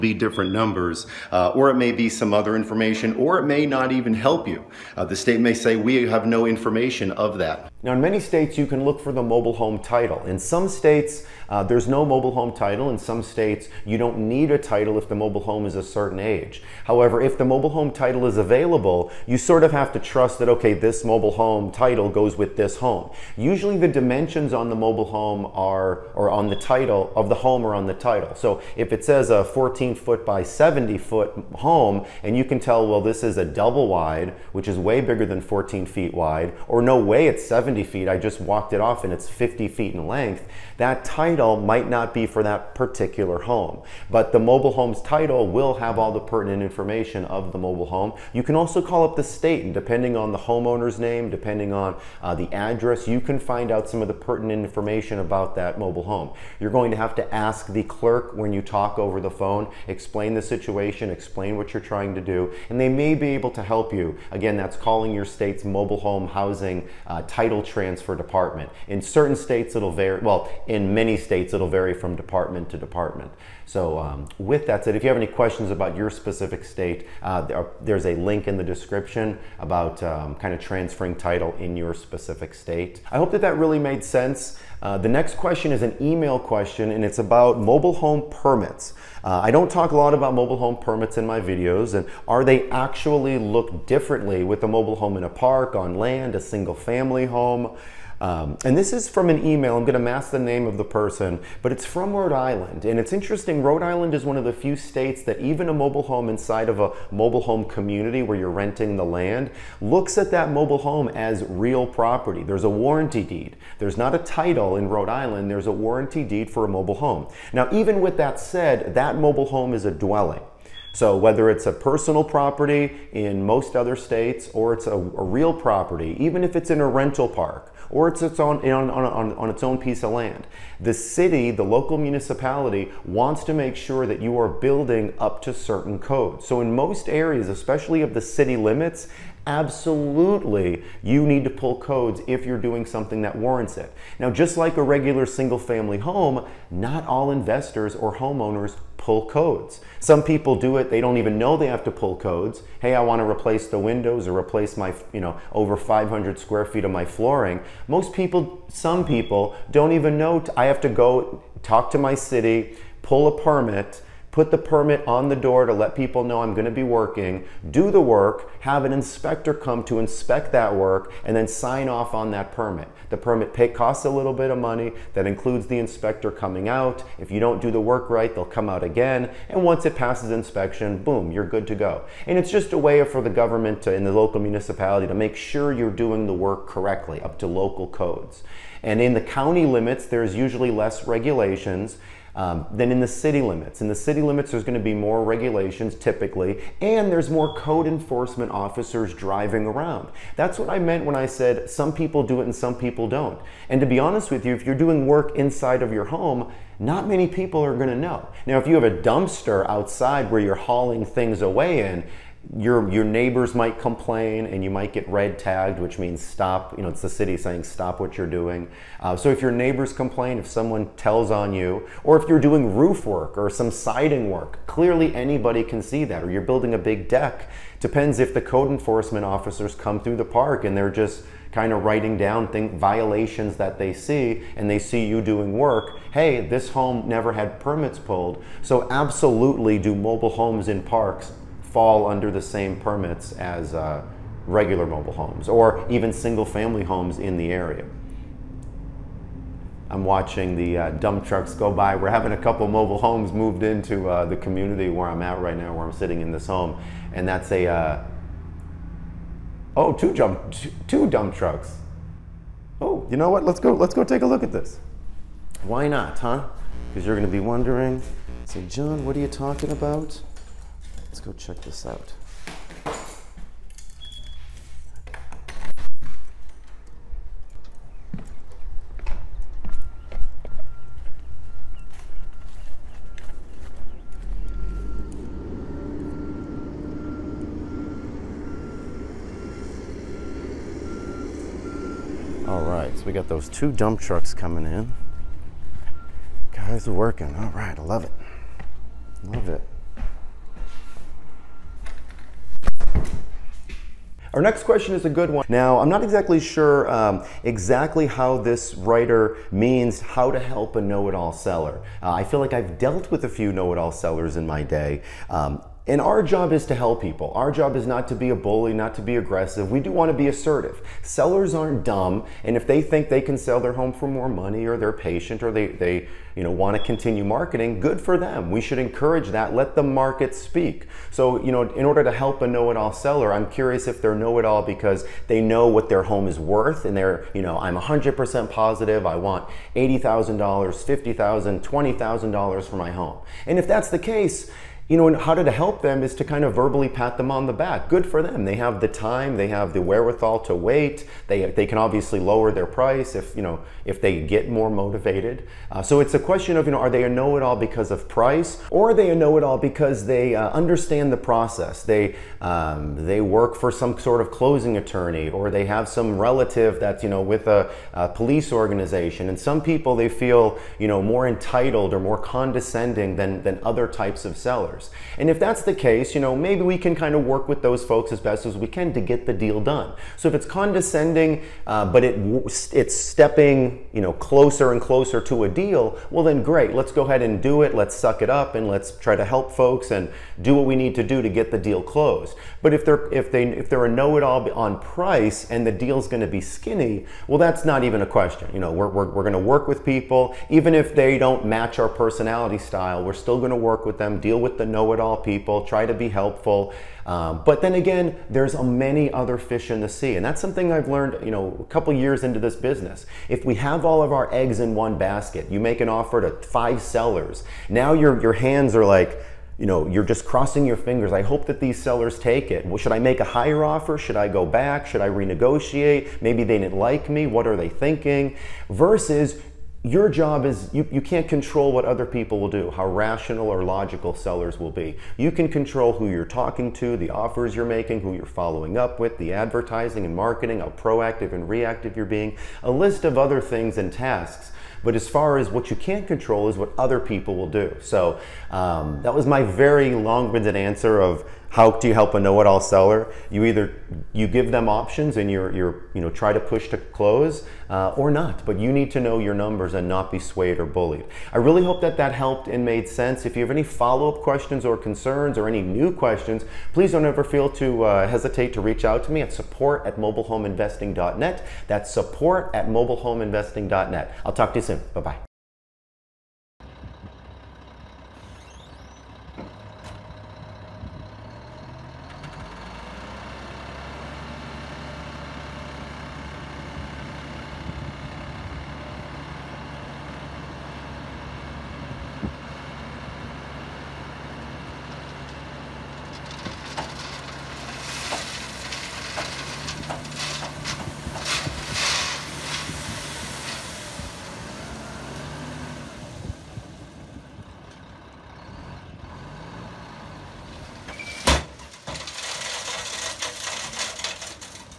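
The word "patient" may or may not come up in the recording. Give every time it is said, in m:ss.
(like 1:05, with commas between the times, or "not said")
5:24.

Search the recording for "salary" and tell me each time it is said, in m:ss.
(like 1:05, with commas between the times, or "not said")
not said.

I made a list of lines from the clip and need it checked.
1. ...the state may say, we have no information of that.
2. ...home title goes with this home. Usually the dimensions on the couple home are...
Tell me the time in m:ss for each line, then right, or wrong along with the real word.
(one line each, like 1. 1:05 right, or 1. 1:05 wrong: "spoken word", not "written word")
1. 0:05 right
2. 0:21 wrong: "mobile", not "couple".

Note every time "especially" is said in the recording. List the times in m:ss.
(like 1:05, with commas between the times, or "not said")
2:17.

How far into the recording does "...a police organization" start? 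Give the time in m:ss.
6:07.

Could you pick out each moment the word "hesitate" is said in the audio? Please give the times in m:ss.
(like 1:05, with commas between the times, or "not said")
7:48.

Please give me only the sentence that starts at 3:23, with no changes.
And to be honest with you, if you're doing work inside of your home, not many people are going to know.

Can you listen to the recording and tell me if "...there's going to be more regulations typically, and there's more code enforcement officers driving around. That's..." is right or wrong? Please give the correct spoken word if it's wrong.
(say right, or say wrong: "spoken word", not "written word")
right.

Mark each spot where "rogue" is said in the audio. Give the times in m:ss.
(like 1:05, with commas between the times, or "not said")
not said.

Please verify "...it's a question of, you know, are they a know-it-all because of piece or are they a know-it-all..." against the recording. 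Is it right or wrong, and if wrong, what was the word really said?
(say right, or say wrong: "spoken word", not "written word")
wrong: "price", not "piece".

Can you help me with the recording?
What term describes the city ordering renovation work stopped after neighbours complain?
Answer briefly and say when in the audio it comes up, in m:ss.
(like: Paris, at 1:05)
red tagged, at 3:35.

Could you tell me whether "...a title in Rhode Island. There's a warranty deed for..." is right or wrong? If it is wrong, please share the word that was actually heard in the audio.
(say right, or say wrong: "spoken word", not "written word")
right.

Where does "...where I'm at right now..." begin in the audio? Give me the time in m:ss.
4:14.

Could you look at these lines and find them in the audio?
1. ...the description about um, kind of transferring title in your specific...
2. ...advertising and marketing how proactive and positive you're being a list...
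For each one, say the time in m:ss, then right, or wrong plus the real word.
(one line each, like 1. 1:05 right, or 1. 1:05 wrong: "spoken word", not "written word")
1. 1:18 right
2. 7:19 wrong: "reactive", not "positive".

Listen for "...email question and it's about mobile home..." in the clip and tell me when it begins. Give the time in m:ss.
1:26.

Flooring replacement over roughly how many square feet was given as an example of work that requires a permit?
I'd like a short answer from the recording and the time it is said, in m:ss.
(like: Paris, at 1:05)
500 square feet, at 2:35.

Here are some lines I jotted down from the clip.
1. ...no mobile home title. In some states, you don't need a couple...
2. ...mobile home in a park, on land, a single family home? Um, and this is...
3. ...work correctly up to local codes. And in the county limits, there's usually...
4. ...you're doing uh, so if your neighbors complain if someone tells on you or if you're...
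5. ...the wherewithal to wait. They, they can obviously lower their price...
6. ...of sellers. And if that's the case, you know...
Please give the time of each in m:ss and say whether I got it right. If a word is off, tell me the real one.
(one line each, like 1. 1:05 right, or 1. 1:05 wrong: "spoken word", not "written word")
1. 0:11 wrong: "title", not "couple"
2. 1:34 right
3. 3:06 right
4. 3:38 right
5. 5:49 right
6. 6:14 right.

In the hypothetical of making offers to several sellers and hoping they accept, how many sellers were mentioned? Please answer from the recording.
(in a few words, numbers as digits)
5.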